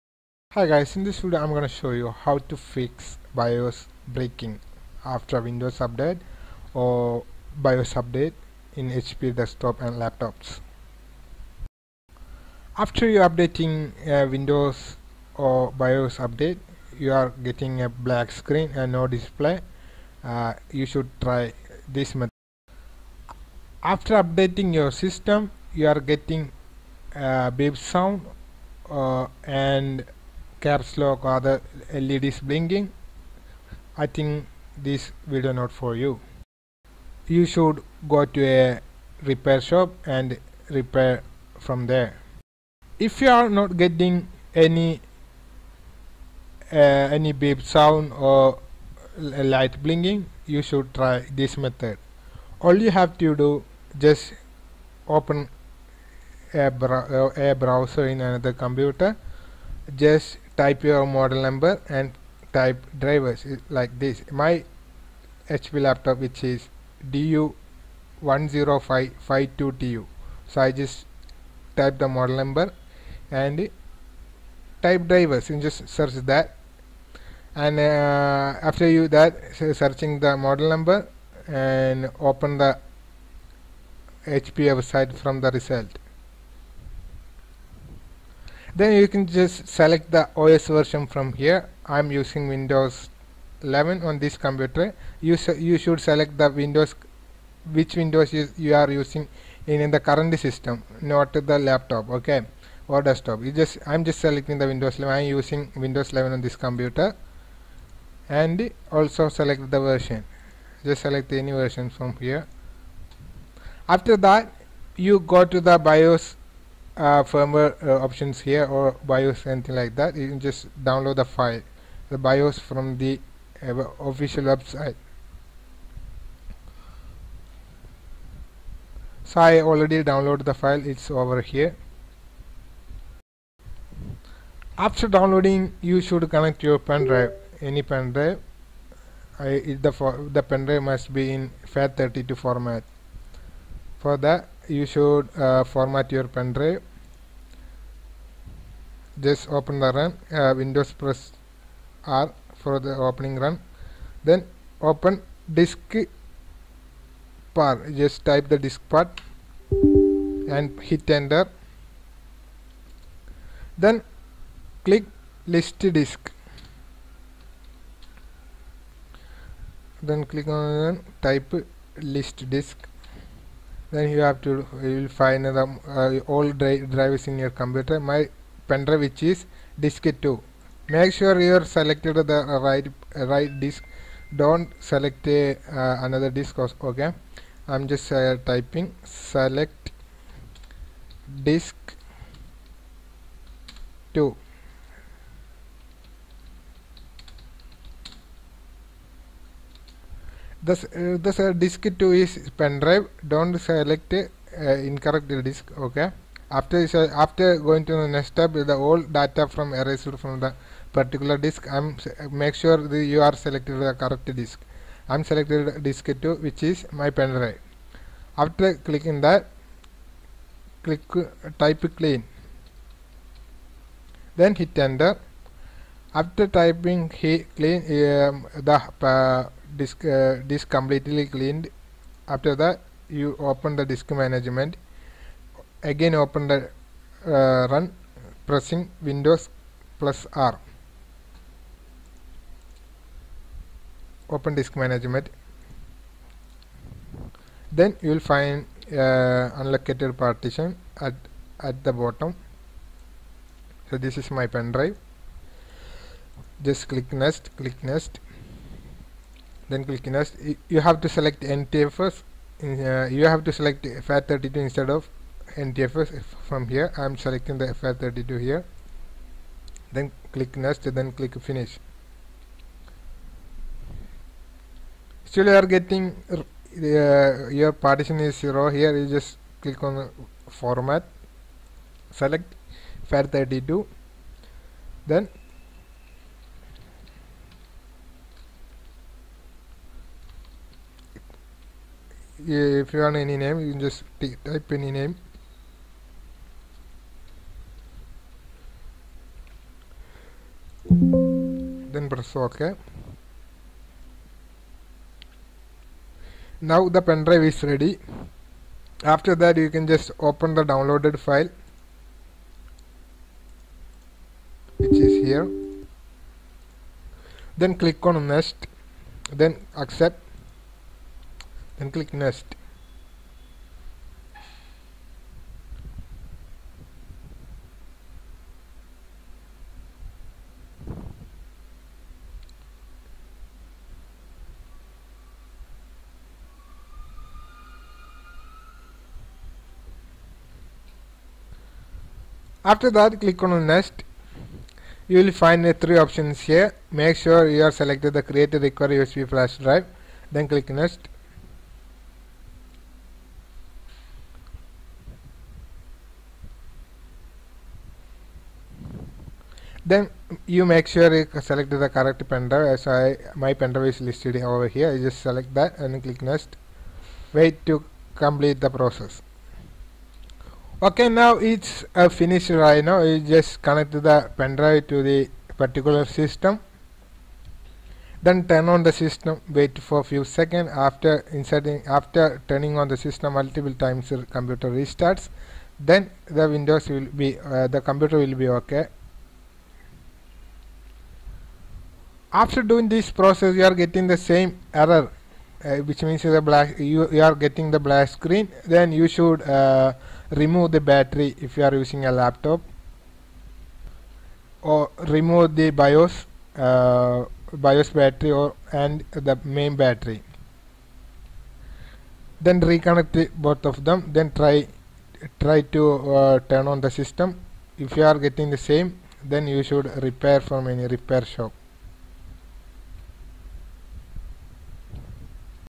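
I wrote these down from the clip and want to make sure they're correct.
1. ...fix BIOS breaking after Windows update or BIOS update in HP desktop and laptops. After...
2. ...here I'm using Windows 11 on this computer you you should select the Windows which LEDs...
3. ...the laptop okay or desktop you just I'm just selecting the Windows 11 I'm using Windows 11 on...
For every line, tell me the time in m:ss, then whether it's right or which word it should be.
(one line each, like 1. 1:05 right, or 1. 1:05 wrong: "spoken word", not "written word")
1. 0:02 right
2. 1:31 wrong: "Windows", not "LEDs"
3. 1:41 right.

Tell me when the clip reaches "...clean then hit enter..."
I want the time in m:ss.
3:41.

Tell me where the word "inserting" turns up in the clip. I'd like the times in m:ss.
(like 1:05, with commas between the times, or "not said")
6:21.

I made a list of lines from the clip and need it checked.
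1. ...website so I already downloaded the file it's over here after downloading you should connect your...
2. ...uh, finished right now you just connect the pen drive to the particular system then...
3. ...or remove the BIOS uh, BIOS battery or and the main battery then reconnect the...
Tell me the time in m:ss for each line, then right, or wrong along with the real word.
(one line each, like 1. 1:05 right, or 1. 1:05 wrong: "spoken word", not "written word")
1. 2:04 right
2. 6:11 right
3. 6:44 right.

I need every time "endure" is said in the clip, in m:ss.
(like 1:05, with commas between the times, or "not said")
not said.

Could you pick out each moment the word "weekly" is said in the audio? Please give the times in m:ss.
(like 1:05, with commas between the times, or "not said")
not said.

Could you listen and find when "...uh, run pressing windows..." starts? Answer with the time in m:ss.
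3:57.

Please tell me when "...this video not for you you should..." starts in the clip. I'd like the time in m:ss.
0:34.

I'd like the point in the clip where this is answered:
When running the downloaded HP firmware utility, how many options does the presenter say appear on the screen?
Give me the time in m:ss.
5:45.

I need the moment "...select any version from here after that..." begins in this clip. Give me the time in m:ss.
1:51.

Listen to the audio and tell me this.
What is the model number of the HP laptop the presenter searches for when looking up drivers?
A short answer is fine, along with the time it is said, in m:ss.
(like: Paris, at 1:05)
DU10552TU, at 1:07.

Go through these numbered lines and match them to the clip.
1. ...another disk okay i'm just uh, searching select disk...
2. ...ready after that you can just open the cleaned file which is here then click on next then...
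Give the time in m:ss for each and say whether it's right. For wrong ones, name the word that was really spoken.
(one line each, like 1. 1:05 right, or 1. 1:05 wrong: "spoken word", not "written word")
1. 3:06 wrong: "typing", not "searching"
2. 5:07 wrong: "downloaded", not "cleaned".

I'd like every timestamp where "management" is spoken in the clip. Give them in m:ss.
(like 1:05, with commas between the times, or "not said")
3:54, 4:04.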